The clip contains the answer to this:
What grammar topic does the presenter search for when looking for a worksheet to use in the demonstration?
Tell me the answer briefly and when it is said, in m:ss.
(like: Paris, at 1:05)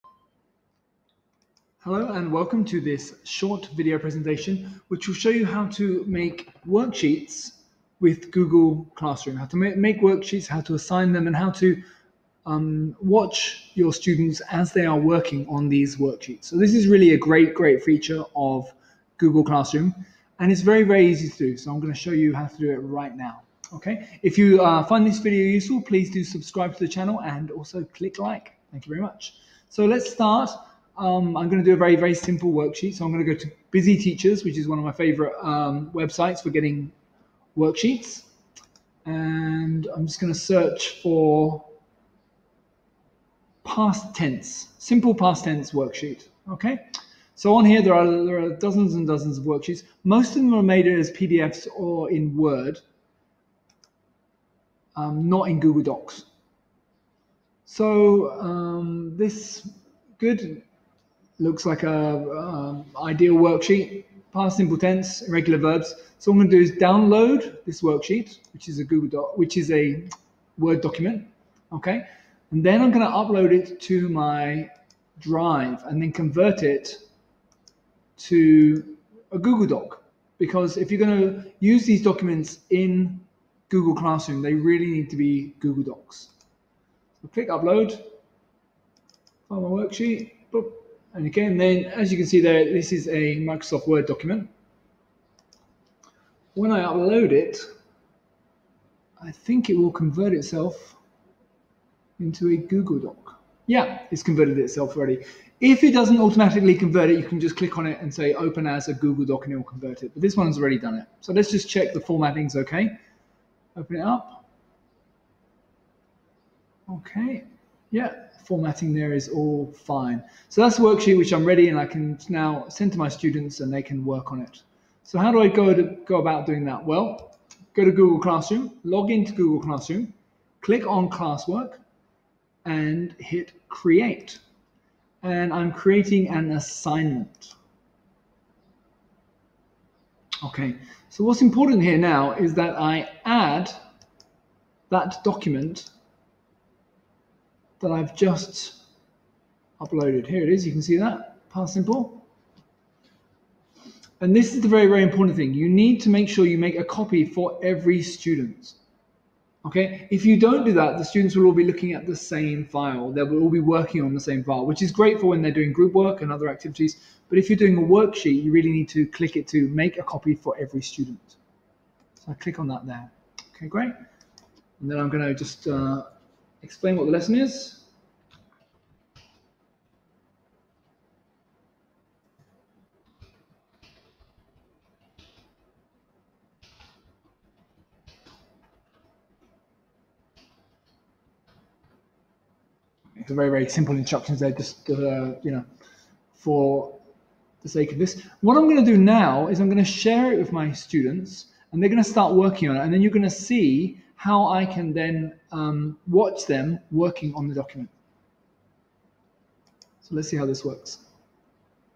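simple past tense, at 0:44.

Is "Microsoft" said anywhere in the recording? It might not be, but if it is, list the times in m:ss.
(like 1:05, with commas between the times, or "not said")
1:33.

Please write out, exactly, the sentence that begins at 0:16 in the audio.
So this is really a great, great feature of Google Classroom and it's very, very easy to do.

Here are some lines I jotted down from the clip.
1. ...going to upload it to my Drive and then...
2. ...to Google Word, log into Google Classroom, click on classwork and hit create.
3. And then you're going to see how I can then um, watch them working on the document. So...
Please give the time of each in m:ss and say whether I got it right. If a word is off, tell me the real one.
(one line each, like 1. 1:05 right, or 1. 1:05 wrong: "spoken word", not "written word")
1. 1:12 right
2. 2:07 wrong: "Classroom", not "Word"
3. 3:22 right.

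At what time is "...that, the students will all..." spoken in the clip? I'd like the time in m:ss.
2:40.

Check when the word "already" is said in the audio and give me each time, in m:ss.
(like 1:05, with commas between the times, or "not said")
1:44, 1:50.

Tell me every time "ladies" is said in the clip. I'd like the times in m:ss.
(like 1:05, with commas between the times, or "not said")
not said.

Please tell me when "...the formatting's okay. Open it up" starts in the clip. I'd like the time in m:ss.
1:51.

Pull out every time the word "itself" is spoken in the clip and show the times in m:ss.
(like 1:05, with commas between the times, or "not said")
1:40, 1:44.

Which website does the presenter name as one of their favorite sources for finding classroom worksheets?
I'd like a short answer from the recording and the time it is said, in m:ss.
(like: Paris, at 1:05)
Busy Teachers, at 0:33.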